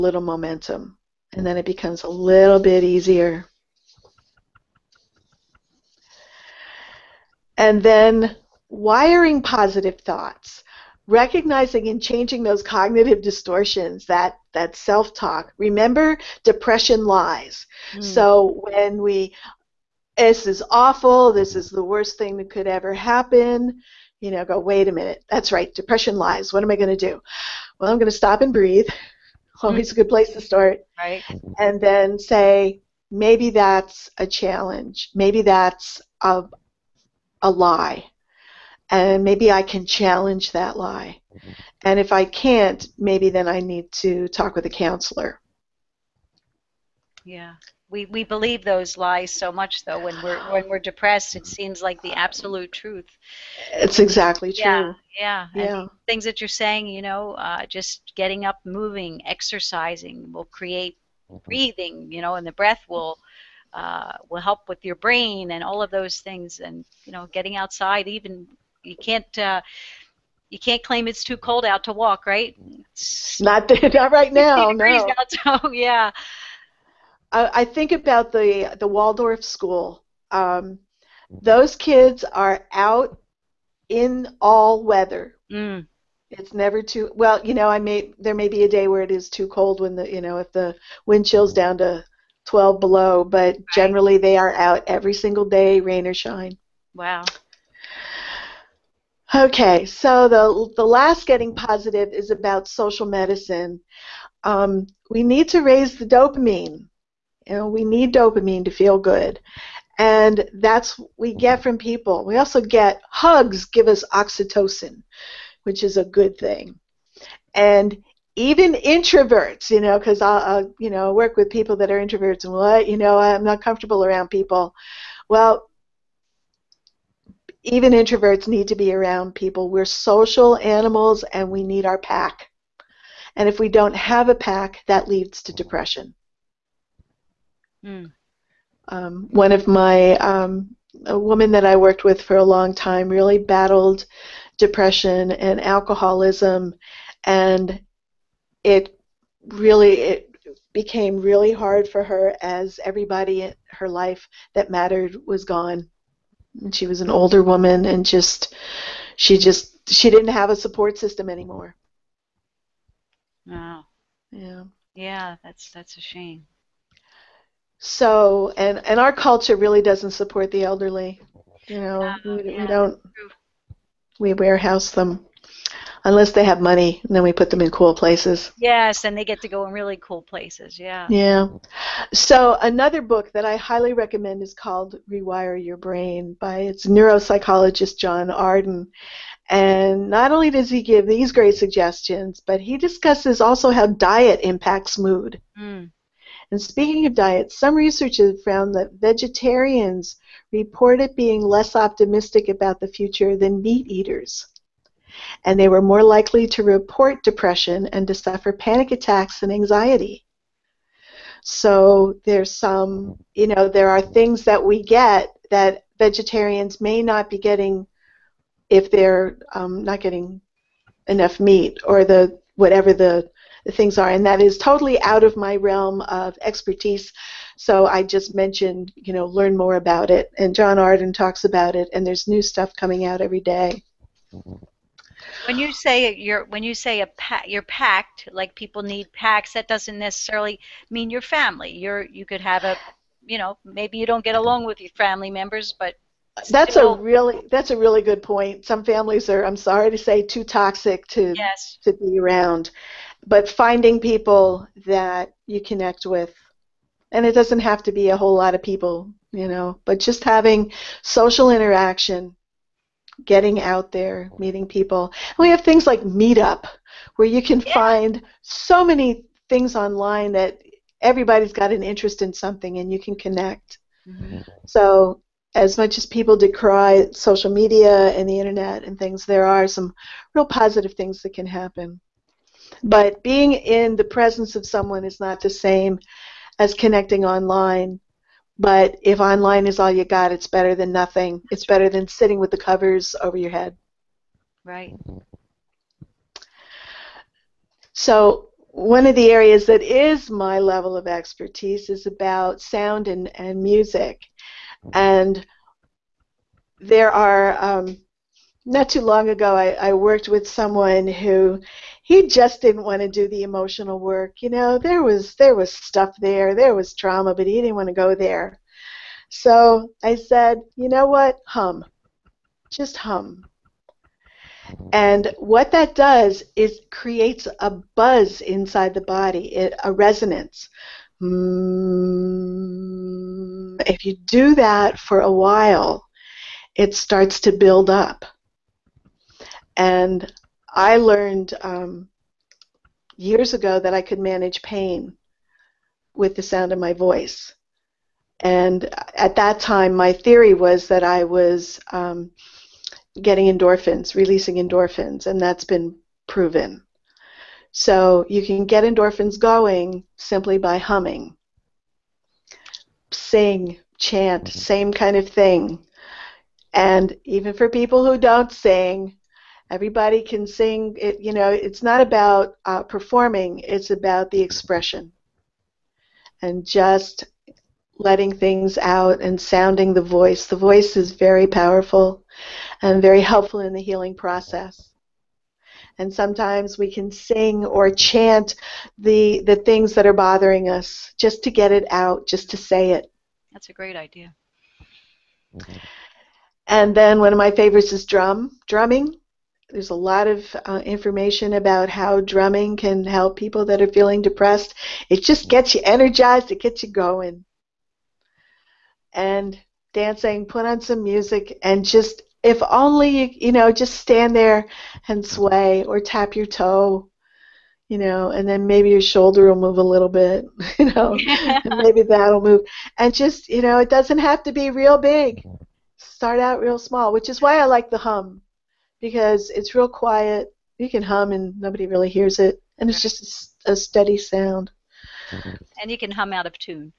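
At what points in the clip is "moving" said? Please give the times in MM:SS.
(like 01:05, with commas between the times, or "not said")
00:58.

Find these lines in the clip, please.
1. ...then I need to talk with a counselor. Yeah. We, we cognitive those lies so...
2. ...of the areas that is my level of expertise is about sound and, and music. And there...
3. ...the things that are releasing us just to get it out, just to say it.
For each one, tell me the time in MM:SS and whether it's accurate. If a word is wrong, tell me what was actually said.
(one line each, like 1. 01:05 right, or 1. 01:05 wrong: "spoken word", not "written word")
1. 00:43 wrong: "believe", not "cognitive"
2. 04:59 right
3. 06:29 wrong: "bothering", not "releasing".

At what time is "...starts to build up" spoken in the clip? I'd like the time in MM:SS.
05:36.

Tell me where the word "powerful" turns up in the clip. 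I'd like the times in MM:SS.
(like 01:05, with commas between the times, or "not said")
06:21.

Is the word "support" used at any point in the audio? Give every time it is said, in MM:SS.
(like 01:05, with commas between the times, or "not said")
02:40, 02:50.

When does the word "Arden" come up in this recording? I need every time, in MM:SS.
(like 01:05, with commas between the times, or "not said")
03:08, 03:50.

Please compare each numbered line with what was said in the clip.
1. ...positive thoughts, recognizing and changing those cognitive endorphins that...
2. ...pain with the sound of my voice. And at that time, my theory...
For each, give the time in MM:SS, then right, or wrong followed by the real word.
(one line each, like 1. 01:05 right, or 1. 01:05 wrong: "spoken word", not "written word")
1. 00:09 wrong: "distortions", not "endorphins"
2. 05:44 right.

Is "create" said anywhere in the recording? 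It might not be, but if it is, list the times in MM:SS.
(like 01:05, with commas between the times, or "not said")
01:00, 05:26.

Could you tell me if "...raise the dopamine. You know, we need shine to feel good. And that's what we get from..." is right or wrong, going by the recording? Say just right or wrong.
wrong.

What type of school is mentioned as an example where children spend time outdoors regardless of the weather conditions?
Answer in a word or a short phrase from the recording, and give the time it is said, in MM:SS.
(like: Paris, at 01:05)
Waldorf school, at 01:18.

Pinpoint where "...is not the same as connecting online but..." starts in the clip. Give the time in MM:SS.
04:45.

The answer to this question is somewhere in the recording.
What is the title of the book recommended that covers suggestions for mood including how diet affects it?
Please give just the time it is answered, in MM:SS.
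03:05.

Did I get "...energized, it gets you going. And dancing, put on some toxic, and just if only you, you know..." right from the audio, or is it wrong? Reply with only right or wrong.
wrong.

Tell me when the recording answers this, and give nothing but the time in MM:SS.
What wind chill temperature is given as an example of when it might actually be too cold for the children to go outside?
01:32.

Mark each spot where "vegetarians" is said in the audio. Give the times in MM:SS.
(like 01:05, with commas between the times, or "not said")
03:18, 03:35.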